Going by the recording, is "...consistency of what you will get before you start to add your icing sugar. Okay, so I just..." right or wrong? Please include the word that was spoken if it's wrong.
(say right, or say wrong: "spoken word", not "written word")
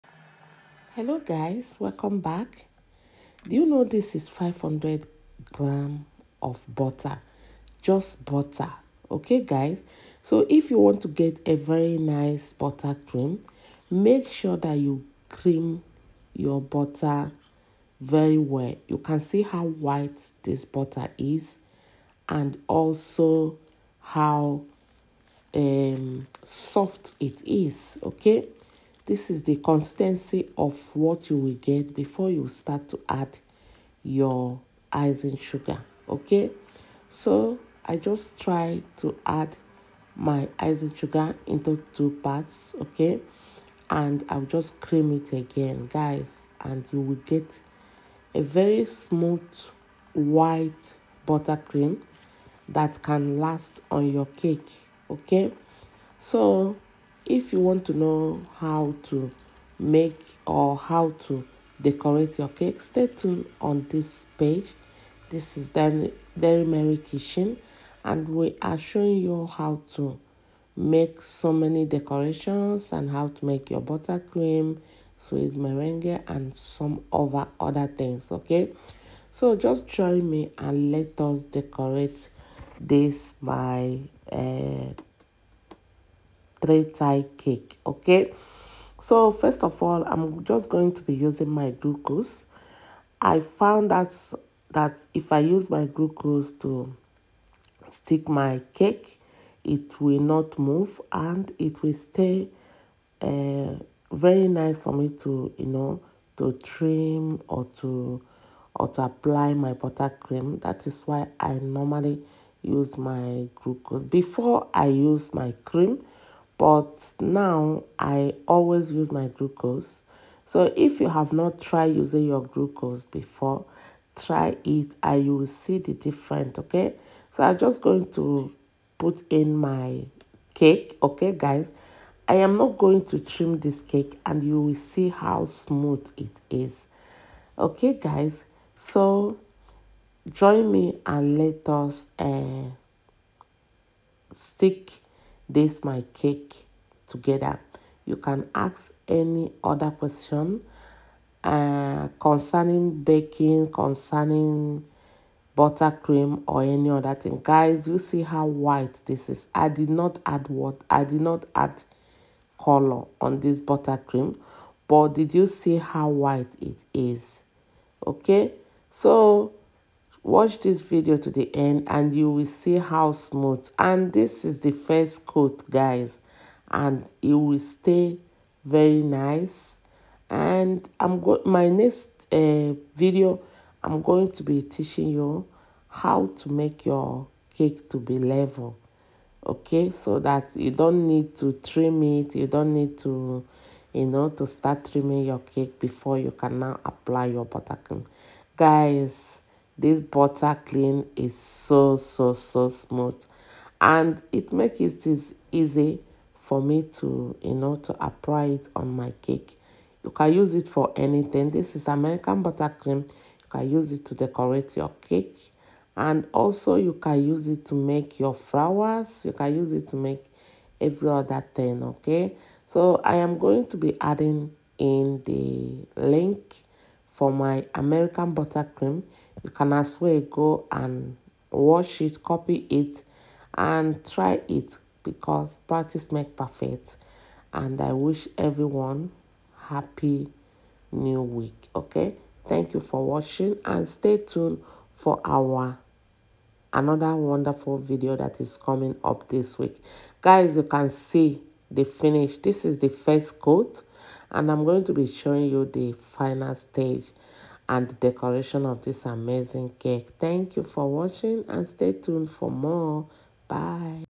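right.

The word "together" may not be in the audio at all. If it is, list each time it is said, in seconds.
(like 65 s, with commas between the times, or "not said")
147 s.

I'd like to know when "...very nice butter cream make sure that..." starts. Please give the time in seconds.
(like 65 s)
11 s.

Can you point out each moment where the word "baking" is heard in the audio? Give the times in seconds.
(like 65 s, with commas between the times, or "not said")
153 s.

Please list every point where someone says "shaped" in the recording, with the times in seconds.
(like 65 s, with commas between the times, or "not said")
not said.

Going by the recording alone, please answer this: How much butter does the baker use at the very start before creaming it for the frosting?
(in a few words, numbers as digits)
500 grams.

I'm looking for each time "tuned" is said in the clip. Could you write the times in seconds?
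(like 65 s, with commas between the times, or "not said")
63 s, 244 s, 261 s.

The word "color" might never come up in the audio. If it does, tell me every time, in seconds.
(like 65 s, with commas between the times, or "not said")
162 s.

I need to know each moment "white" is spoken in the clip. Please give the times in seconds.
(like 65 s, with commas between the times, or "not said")
19 s, 50 s, 158 s, 166 s.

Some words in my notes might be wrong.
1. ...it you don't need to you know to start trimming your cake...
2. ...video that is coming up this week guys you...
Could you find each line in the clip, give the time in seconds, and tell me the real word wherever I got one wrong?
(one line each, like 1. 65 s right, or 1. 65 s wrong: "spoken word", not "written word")
1. 192 s right
2. 247 s right.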